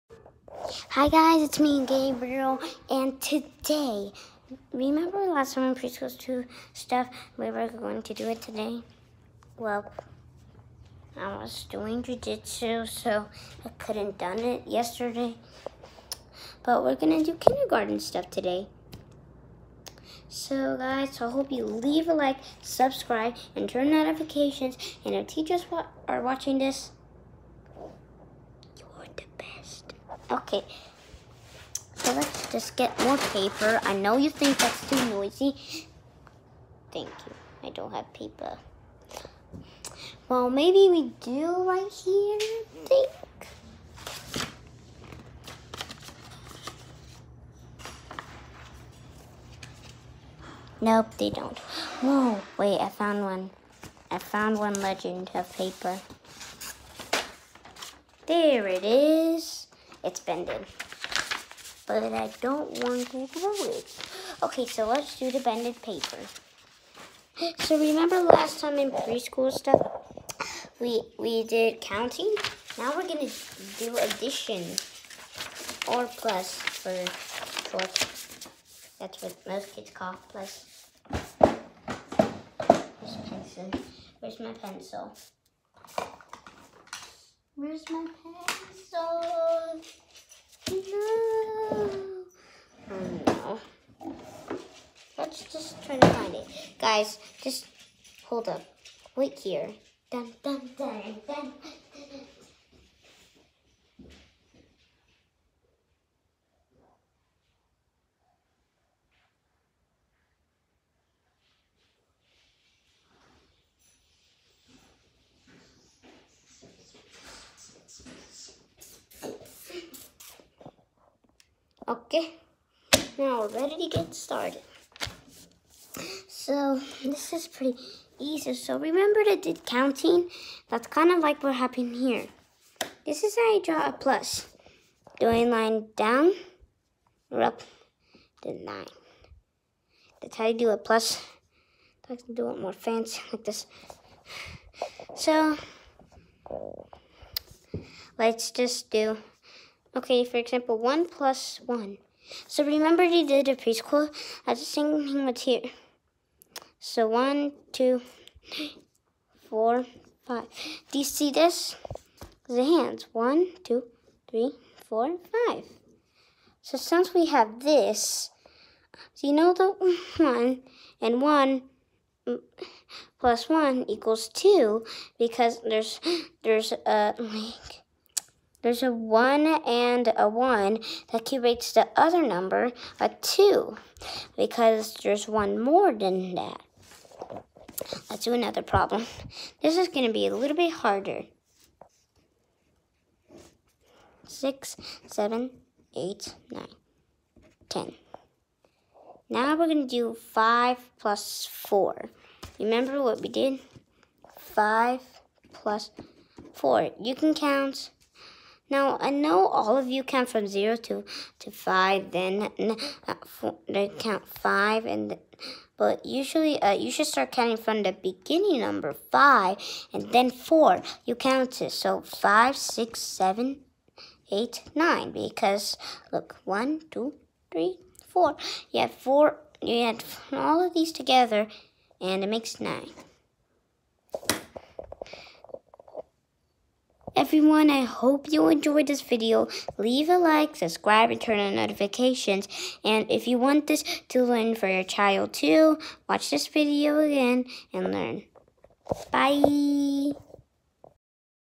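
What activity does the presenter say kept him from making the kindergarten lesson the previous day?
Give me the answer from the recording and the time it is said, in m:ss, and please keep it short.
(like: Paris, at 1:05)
Jujitsu, at 0:12.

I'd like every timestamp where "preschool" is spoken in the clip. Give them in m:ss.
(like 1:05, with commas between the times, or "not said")
0:05, 1:08, 2:33.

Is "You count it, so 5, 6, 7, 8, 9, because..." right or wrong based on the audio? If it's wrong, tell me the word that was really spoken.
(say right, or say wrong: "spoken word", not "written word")
right.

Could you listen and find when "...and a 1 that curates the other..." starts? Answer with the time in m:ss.
2:59.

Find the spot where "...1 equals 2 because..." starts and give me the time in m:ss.
2:53.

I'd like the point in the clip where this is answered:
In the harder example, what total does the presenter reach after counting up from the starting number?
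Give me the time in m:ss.
3:52.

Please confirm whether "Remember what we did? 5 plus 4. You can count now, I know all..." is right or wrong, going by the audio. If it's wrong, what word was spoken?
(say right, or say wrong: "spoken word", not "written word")
right.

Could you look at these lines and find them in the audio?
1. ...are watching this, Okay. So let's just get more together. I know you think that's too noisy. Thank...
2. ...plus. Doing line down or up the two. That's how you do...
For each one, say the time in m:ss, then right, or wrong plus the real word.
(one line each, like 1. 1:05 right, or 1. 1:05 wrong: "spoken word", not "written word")
1. 0:26 wrong: "paper", not "together"
2. 2:13 wrong: "nine", not "two".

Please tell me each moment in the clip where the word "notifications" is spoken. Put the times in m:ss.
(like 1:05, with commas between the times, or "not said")
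0:23, 4:01.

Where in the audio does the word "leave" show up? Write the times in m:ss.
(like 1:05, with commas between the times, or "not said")
0:21, 3:59.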